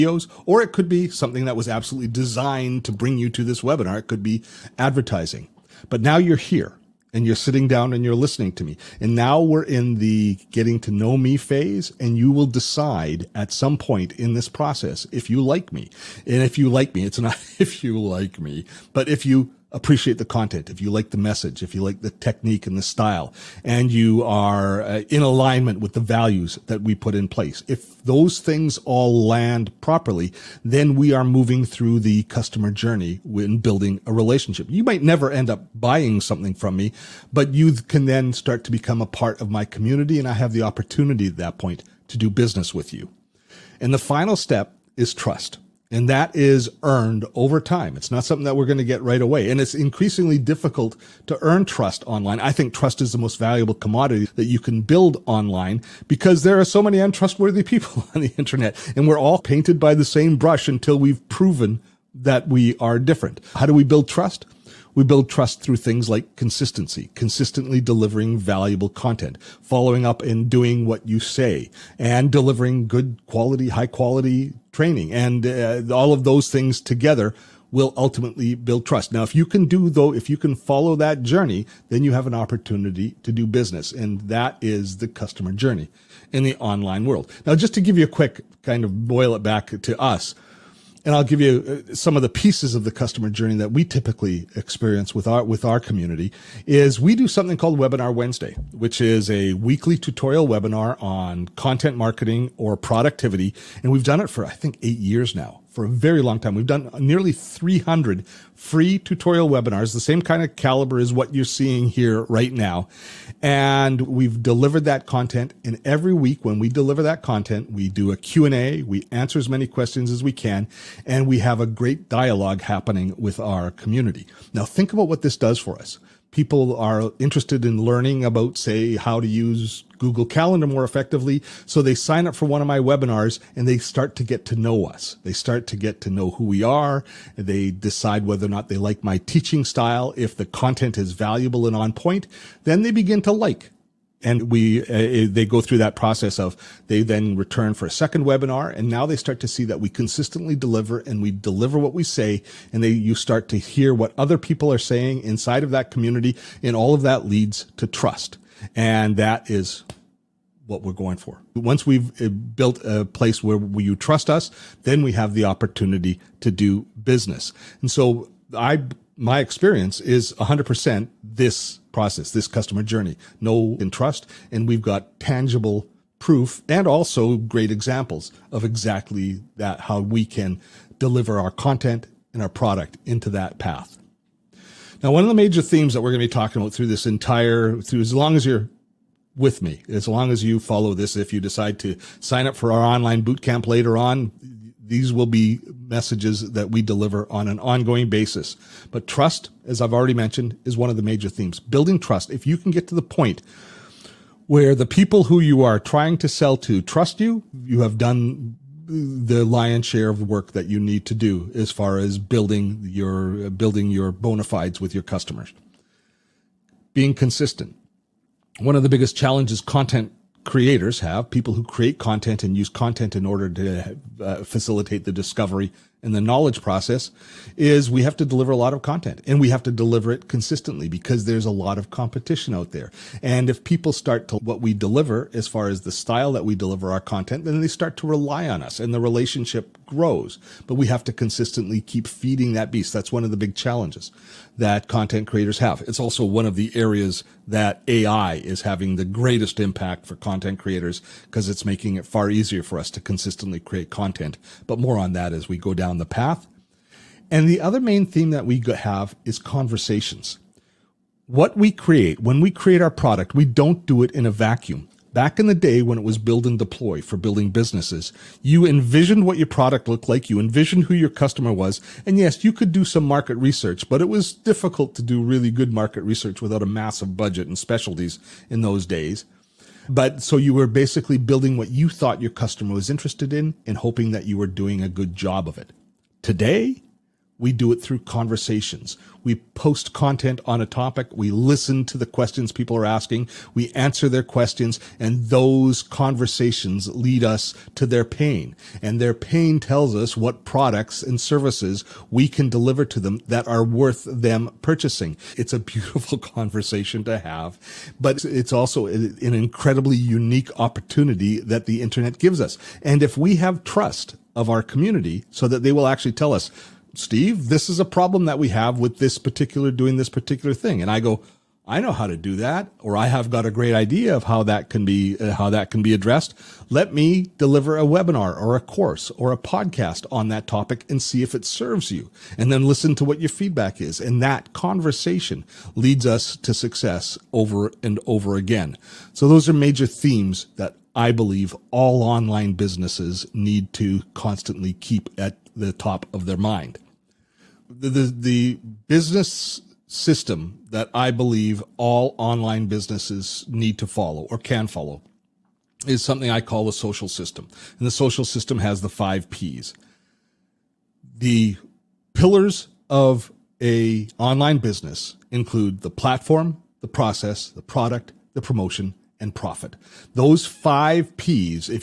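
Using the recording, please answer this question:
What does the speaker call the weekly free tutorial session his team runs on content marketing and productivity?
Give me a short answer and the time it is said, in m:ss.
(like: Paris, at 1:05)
Webinar Wednesday, at 1:37.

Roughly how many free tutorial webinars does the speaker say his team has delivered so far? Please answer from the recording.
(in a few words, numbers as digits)
300.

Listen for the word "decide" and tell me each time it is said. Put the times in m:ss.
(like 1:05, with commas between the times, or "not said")
0:12, 2:17, 3:11.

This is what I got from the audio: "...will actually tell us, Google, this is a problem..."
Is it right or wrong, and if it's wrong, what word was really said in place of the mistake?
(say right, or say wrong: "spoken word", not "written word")
wrong: "Steve", not "Google".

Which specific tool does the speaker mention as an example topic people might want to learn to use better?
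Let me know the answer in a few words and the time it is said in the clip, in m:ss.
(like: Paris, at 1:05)
Google Calendar, at 2:10.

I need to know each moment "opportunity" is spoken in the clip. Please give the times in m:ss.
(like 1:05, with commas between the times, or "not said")
0:40, 1:22, 2:45, 5:10.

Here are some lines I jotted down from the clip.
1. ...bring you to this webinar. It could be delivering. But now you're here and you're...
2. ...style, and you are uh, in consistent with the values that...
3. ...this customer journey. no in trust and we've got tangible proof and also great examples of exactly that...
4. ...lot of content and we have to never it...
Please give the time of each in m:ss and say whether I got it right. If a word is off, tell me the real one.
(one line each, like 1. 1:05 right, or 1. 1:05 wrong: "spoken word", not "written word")
1. 0:02 wrong: "advertising", not "delivering"
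2. 0:22 wrong: "alignment", not "consistent"
3. 2:52 right
4. 3:48 wrong: "deliver", not "never".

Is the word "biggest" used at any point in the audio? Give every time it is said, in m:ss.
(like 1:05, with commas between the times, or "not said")
3:38.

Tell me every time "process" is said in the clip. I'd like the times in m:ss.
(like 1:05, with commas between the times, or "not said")
0:14, 2:25, 2:51, 3:46, 6:06.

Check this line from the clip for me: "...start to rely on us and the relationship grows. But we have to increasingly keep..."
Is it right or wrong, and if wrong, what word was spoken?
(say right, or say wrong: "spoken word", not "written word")
wrong: "consistently", not "increasingly".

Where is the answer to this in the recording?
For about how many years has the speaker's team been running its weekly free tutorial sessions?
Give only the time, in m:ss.
1:44.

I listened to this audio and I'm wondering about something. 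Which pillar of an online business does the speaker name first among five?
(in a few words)
platform.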